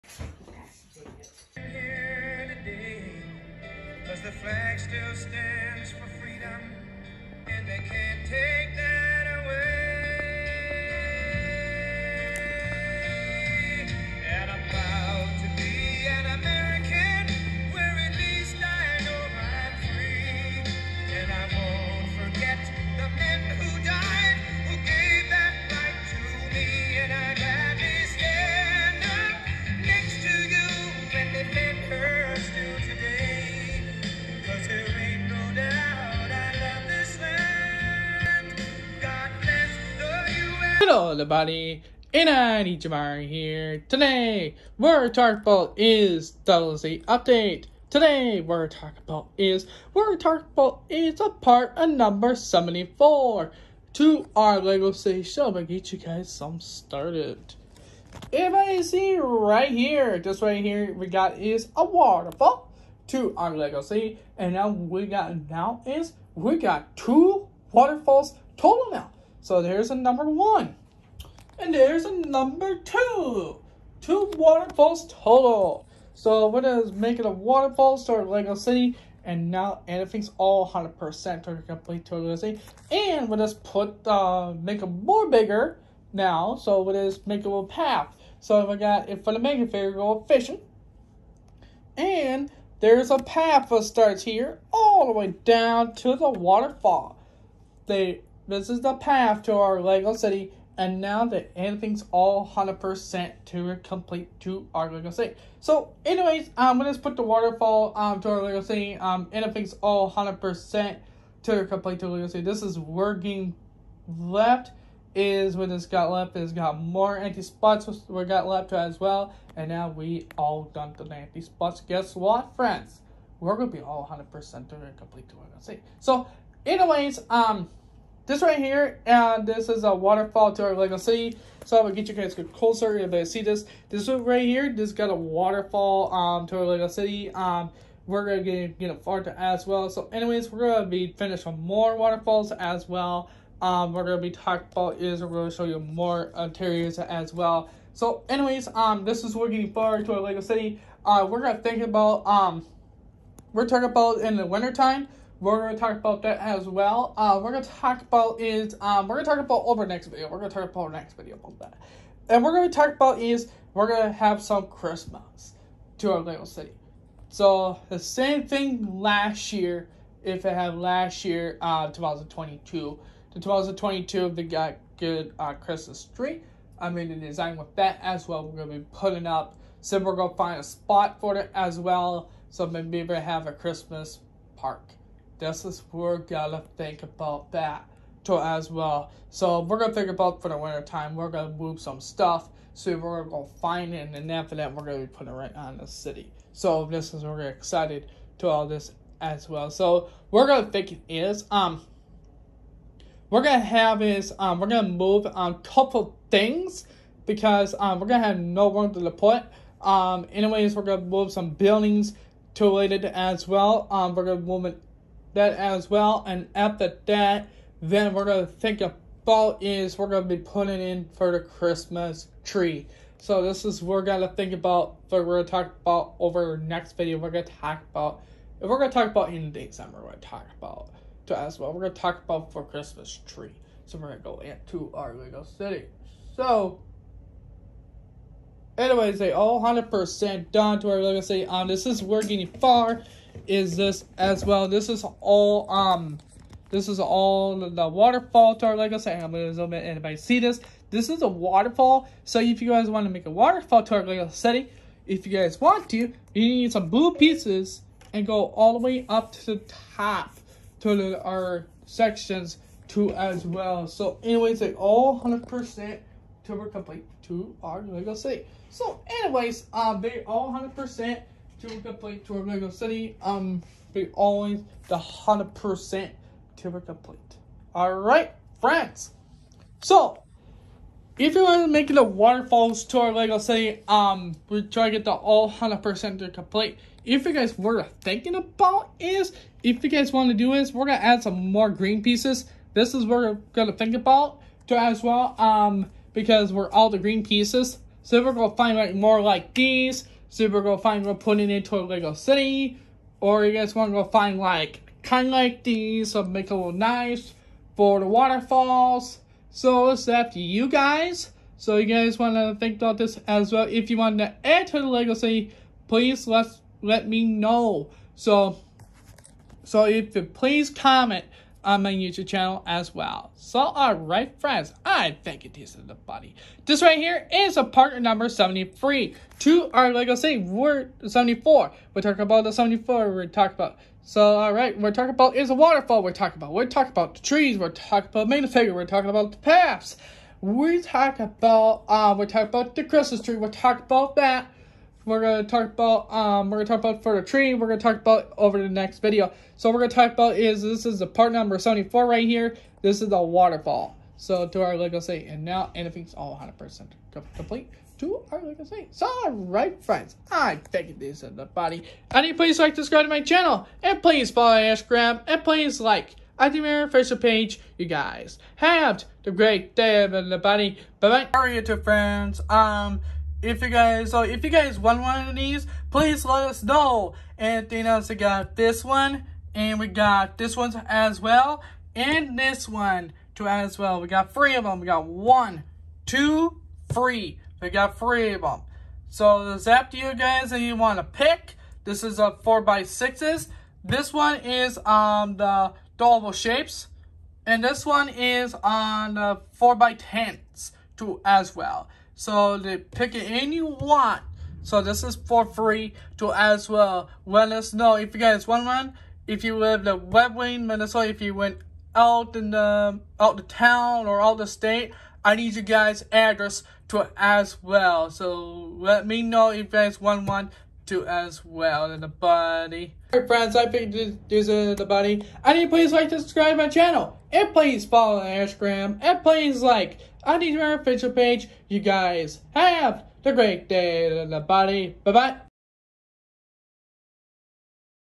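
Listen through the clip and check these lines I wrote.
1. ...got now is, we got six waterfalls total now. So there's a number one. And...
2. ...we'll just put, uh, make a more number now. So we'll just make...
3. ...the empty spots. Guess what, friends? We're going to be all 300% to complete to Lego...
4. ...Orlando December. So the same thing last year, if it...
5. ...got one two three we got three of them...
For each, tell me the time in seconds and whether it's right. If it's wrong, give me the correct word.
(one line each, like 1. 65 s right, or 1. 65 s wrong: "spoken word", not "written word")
1. 65 s wrong: "two", not "six"
2. 83 s wrong: "bigger", not "number"
3. 120 s wrong: "100", not "300"
4. 166 s wrong: "City", not "December"
5. 384 s right.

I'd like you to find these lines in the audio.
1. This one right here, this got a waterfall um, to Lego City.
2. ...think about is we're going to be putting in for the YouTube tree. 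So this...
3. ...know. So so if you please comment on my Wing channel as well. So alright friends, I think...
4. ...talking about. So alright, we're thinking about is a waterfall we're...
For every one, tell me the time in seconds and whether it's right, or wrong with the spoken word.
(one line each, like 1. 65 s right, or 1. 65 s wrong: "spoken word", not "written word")
1. 133 s right
2. 218 s wrong: "Christmas", not "YouTube"
3. 317 s wrong: "YouTube", not "Wing"
4. 333 s wrong: "talking", not "thinking".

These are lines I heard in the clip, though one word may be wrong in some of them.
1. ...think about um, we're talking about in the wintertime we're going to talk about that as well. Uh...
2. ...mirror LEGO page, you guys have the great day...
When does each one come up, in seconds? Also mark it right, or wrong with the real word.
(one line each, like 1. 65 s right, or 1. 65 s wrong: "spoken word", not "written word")
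1. 151 s right
2. 366 s wrong: "Facebook", not "LEGO".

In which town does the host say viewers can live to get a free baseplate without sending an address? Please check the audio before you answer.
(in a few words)
Red Wing, Minnesota.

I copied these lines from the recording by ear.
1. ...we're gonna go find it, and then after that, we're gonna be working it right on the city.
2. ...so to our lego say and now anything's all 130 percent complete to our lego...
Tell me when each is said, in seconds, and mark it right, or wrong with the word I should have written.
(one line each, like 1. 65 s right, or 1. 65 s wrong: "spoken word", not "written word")
1. 192 s wrong: "putting", not "working"
2. 354 s wrong: "100", not "130".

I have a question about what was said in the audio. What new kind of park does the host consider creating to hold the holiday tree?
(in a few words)
Christmas park.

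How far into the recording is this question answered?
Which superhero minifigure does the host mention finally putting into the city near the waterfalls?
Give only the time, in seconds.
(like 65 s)
300 s.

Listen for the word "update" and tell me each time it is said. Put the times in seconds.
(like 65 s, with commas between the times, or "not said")
47 s.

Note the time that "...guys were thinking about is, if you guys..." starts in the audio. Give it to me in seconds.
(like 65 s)
287 s.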